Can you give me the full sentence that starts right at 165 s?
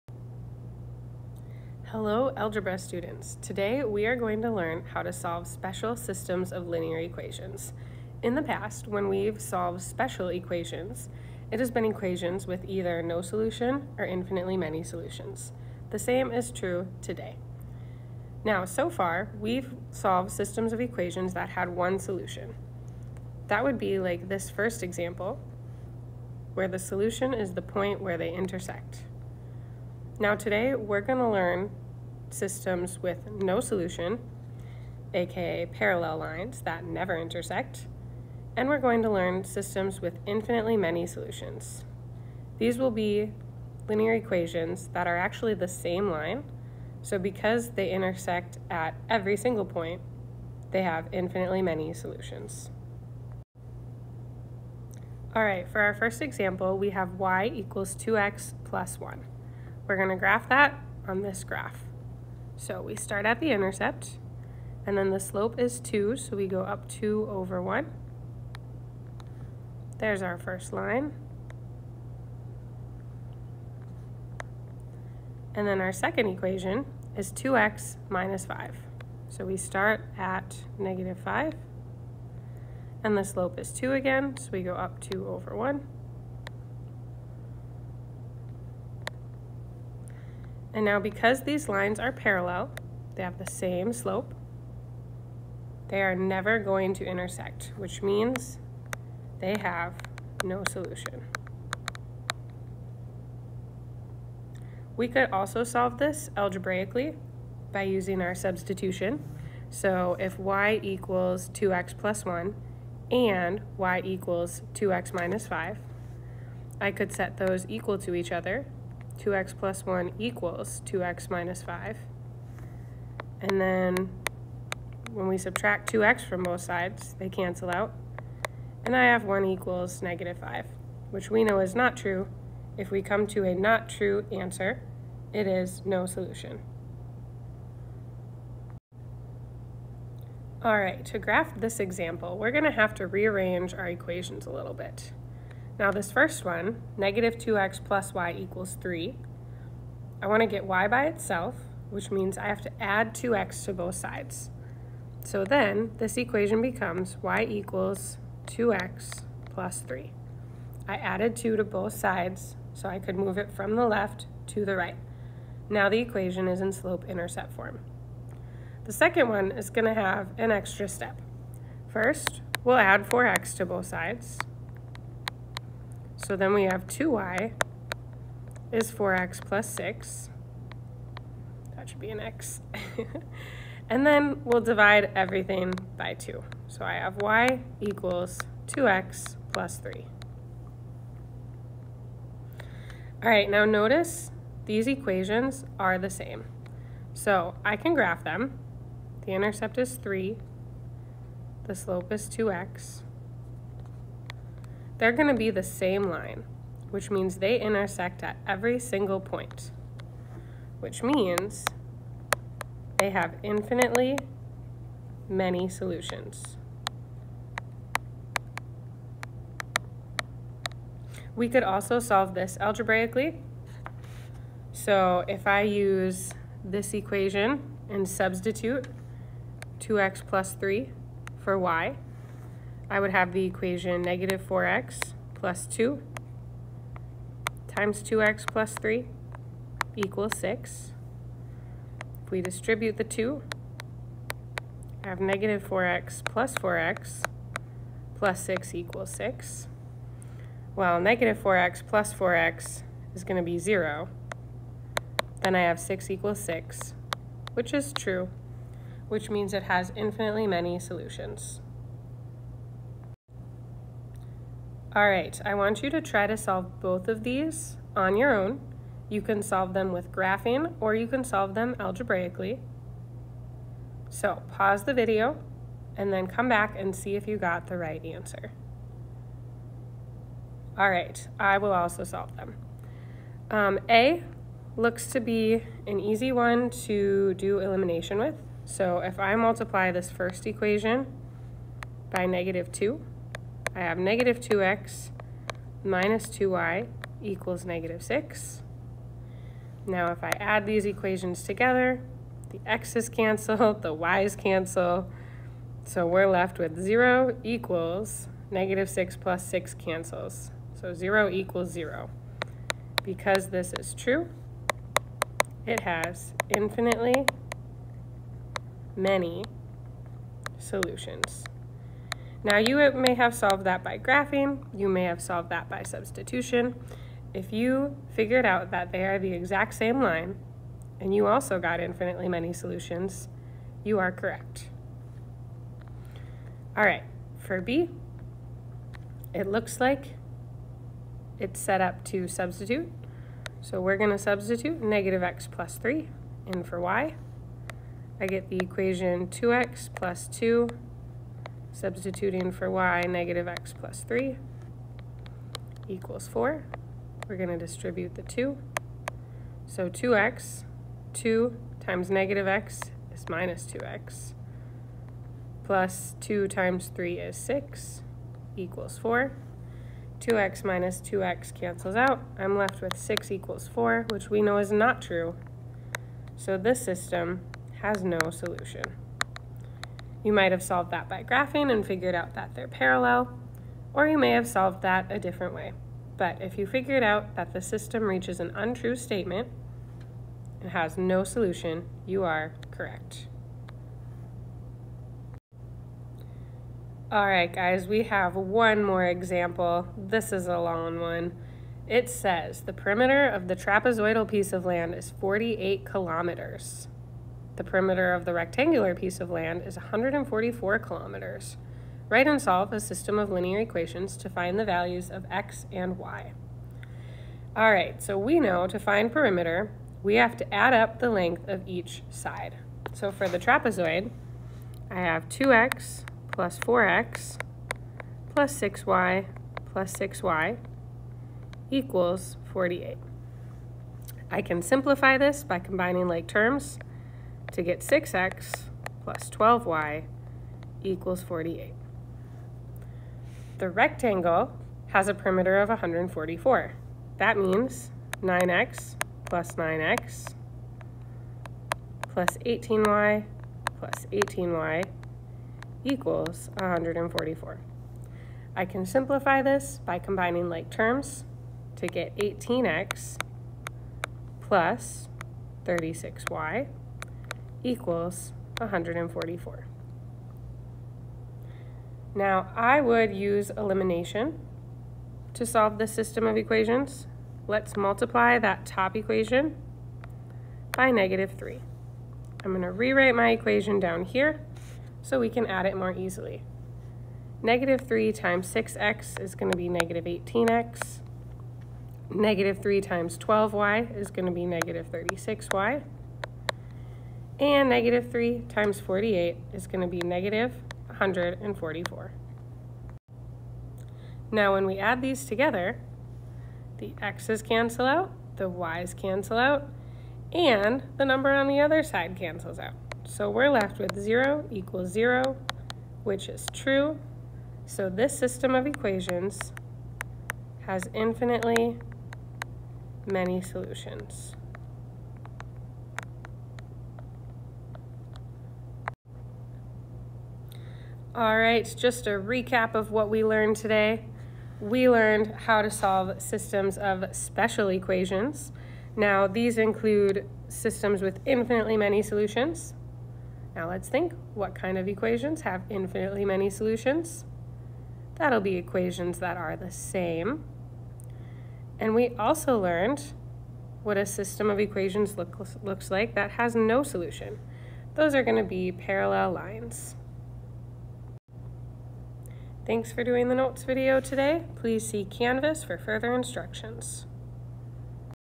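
Now the equation is in slope-intercept form.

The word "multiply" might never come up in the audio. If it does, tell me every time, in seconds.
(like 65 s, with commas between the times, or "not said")
289 s, 477 s.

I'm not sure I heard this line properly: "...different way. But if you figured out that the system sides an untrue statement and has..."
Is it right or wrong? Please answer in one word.
wrong.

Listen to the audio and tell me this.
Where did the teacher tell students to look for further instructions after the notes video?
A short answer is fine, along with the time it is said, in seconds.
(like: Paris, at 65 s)
Canvas, at 565 s.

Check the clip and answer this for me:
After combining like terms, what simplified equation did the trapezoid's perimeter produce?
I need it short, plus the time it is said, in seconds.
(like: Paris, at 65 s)
6x + 12y = 48, at 437 s.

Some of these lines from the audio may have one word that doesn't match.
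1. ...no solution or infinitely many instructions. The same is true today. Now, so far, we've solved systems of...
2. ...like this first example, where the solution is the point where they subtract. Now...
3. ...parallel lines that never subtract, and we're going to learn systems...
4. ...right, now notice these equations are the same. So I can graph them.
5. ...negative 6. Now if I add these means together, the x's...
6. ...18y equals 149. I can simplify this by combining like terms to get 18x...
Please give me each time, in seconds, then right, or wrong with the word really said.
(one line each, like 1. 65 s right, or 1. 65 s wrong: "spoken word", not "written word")
1. 13 s wrong: "solutions", not "instructions"
2. 23 s wrong: "intersect", not "subtract"
3. 35 s wrong: "intersect", not "subtract"
4. 193 s right
5. 297 s wrong: "equations", not "means"
6. 454 s wrong: "144", not "149".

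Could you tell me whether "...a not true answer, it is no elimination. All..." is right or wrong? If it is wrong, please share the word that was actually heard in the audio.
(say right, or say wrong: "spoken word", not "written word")
wrong: "solution", not "elimination".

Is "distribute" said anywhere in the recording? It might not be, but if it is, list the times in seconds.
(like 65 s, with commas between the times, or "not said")
242 s, 357 s.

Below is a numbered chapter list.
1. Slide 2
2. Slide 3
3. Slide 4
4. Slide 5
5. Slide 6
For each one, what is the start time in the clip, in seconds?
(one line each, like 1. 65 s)
1. 53 s
2. 139 s
3. 263 s
4. 395 s
5. 529 s.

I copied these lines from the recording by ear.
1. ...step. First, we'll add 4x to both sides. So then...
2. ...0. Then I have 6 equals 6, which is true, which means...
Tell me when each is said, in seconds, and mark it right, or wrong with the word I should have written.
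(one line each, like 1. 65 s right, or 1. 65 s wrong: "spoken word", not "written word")
1. 170 s right
2. 253 s right.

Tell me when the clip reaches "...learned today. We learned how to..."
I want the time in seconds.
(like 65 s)
533 s.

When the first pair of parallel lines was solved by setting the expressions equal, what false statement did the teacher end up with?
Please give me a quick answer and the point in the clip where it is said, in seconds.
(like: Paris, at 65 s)
1 equals -5, at 129 s.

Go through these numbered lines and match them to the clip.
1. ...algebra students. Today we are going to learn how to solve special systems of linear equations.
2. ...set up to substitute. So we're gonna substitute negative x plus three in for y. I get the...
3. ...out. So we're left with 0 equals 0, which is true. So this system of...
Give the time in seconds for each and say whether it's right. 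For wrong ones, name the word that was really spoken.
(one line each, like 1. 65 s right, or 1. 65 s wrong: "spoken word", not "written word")
1. 2 s right
2. 341 s right
3. 512 s right.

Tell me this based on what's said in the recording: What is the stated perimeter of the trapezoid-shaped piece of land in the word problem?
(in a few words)
48 kilometers.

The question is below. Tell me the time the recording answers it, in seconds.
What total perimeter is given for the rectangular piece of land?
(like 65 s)
409 s.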